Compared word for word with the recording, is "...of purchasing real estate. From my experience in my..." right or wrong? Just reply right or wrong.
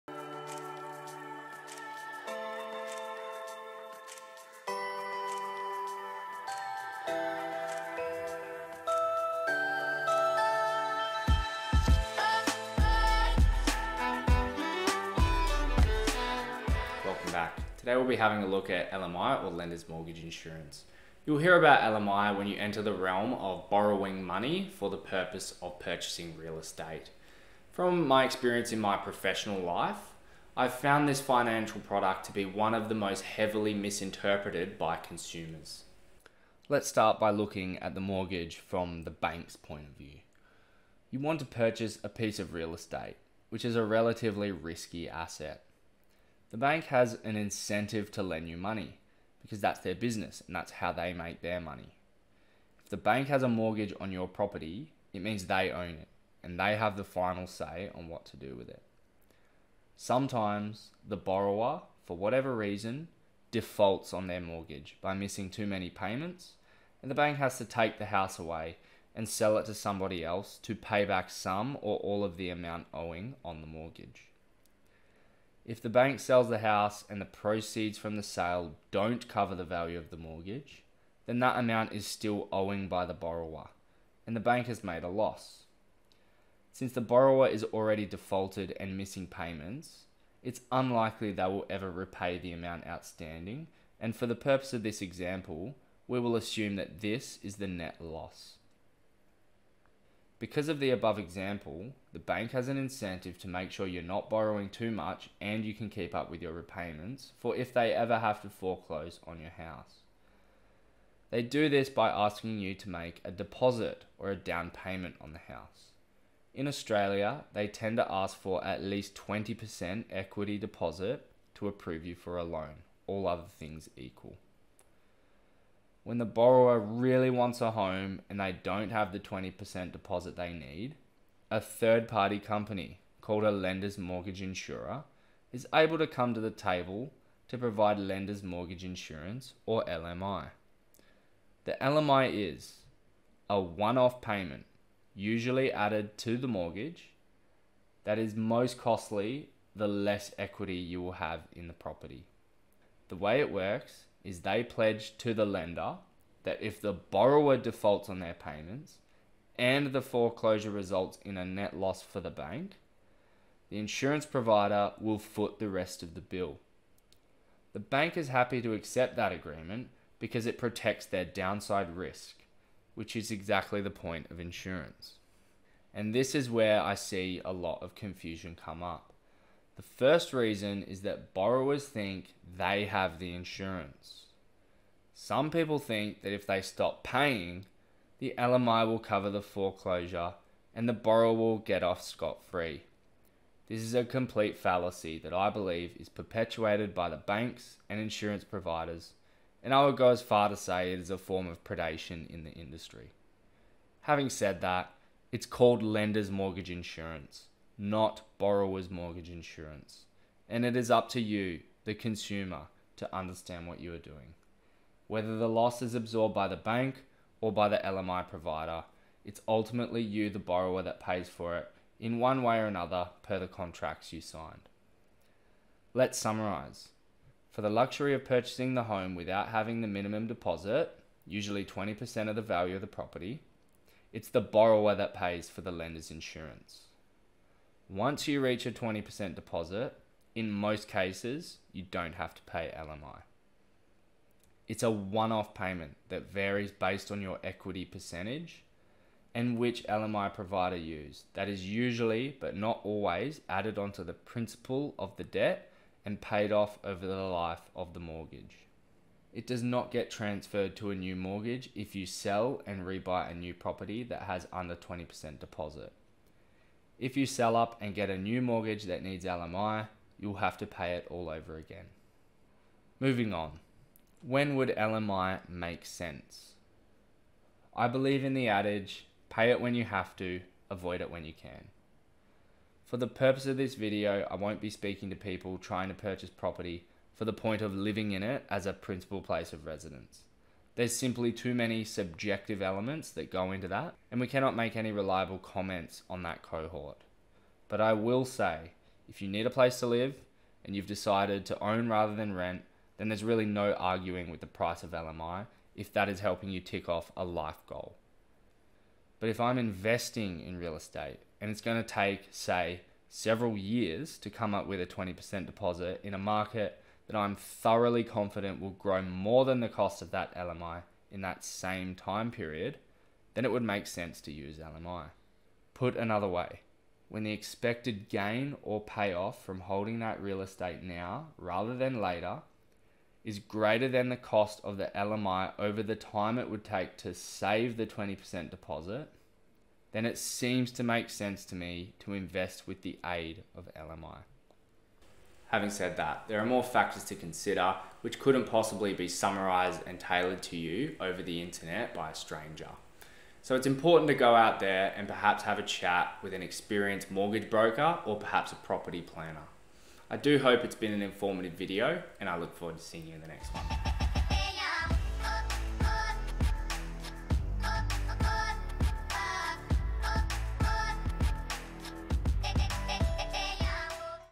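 right.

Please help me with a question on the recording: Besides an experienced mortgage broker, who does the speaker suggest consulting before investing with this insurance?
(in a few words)
property planner.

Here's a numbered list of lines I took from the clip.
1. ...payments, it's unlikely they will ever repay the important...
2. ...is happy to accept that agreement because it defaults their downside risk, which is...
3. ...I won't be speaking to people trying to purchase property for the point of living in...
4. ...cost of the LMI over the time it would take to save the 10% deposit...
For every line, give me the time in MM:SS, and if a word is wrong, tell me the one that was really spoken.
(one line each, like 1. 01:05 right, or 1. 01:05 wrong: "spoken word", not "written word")
1. 01:29 wrong: "amount", not "important"
2. 02:48 wrong: "protects", not "defaults"
3. 04:44 right
4. 05:34 wrong: "20", not "10".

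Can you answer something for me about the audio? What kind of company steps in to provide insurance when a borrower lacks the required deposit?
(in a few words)
lender's mortgage insurer.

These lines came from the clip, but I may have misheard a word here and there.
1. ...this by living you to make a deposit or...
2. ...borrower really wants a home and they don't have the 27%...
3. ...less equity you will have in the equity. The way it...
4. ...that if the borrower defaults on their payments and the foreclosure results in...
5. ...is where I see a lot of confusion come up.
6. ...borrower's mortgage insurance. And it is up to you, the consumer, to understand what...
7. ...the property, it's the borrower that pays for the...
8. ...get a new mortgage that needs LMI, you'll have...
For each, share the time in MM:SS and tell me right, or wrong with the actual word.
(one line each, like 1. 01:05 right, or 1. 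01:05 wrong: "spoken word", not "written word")
1. 01:51 wrong: "asking", not "living"
2. 02:06 wrong: "20", not "27"
3. 02:29 wrong: "property", not "equity"
4. 02:36 right
5. 02:56 right
6. 03:28 right
7. 03:52 right
8. 04:27 right.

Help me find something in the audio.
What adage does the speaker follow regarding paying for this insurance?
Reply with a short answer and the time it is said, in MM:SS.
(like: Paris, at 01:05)
pay it when you have to, avoid it when you can, at 04:39.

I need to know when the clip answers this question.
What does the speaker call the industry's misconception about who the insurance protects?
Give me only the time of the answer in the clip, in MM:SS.
03:21.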